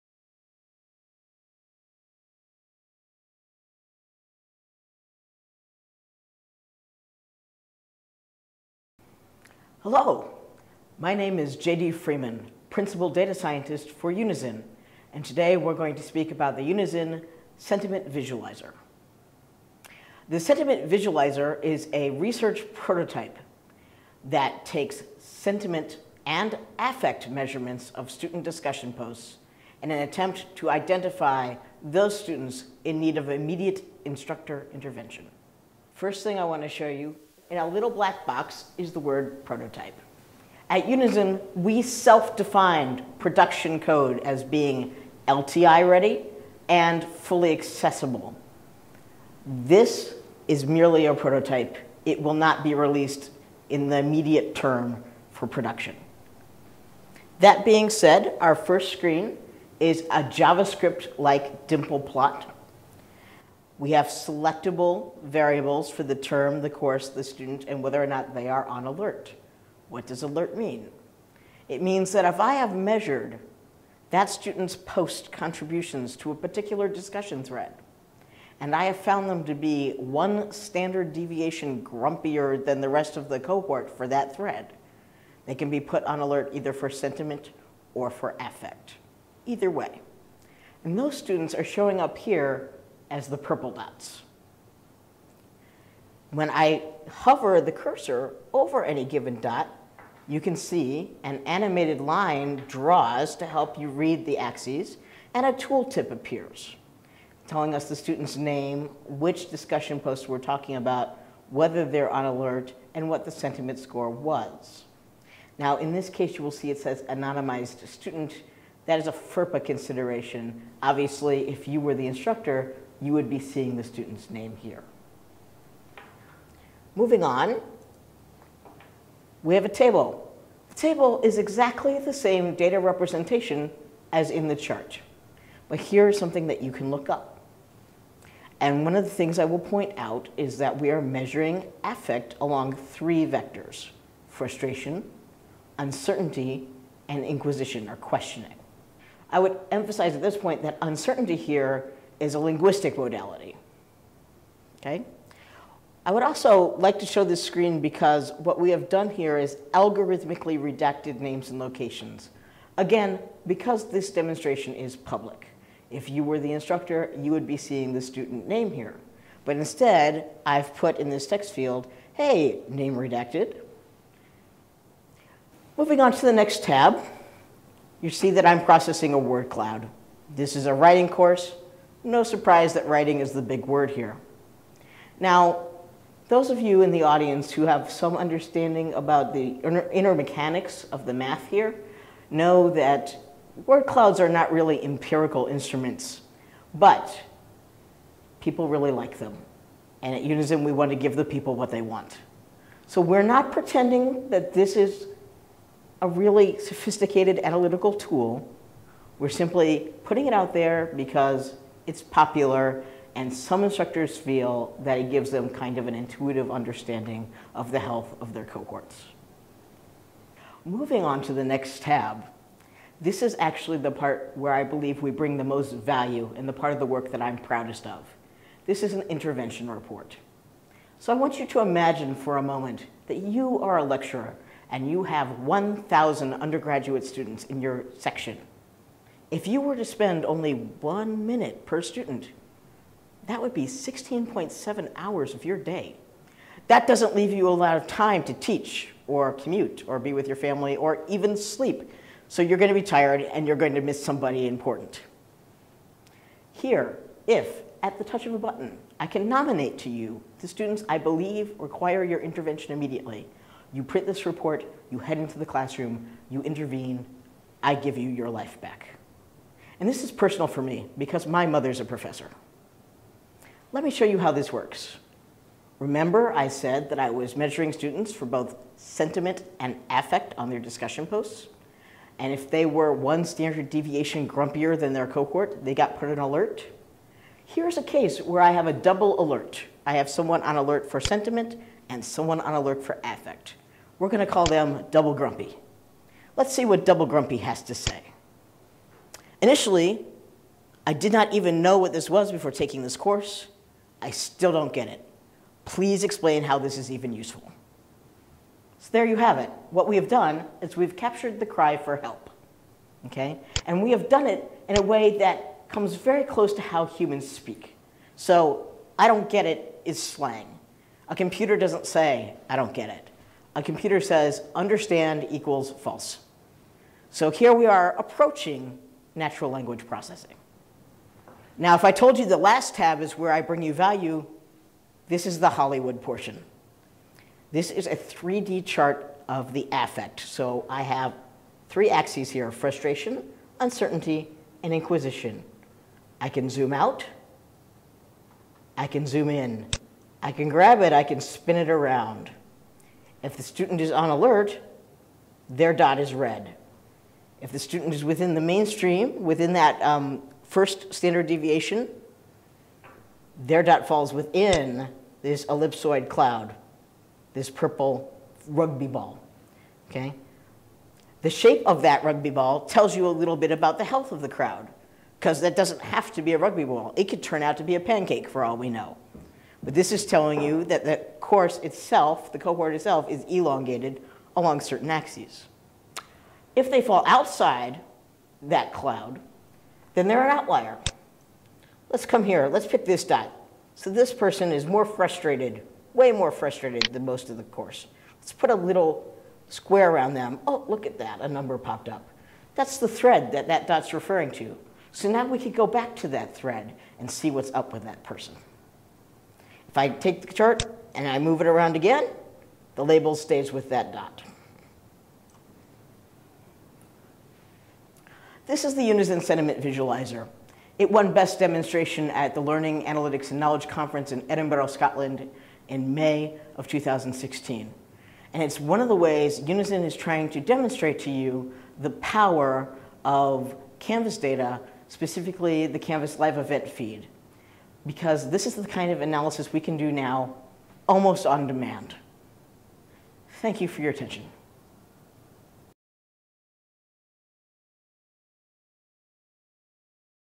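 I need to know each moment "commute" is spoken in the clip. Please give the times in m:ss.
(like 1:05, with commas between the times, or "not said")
4:09.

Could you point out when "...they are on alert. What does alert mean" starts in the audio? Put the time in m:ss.
1:08.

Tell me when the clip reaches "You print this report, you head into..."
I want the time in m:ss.
4:23.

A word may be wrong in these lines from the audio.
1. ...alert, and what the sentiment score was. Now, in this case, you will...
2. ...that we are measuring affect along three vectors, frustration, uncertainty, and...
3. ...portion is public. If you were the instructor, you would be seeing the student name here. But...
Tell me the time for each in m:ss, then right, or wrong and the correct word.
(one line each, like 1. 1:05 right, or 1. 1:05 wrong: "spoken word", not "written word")
1. 1:52 right
2. 2:20 right
3. 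2:44 wrong: "demonstration", not "portion".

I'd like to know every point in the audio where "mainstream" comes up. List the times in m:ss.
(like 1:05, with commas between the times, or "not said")
5:58.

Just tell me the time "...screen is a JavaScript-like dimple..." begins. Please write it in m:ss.
0:58.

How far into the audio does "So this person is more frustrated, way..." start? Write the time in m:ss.
6:33.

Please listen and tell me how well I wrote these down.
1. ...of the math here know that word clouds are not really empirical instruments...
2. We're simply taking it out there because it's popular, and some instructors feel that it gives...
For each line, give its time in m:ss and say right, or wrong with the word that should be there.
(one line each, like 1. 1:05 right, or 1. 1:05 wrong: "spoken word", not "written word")
1. 3:10 right
2. 3:29 wrong: "putting", not "taking".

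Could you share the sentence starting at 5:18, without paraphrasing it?
So I don't get it is slang.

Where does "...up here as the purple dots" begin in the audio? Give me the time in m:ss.
1:31.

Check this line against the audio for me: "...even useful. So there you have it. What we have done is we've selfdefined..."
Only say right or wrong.
wrong.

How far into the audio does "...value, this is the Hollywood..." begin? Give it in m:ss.
5:33.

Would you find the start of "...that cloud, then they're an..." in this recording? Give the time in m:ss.
6:28.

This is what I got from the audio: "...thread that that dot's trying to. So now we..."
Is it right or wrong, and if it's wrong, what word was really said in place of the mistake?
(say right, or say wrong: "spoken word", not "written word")
wrong: "referring", not "trying".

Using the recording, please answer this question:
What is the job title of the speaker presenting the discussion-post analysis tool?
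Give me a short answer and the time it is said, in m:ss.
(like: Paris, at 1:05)
Principal Data Scientist, at 0:12.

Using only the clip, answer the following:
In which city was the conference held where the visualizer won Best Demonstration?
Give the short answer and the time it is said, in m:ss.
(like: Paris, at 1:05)
Edinburgh, at 7:04.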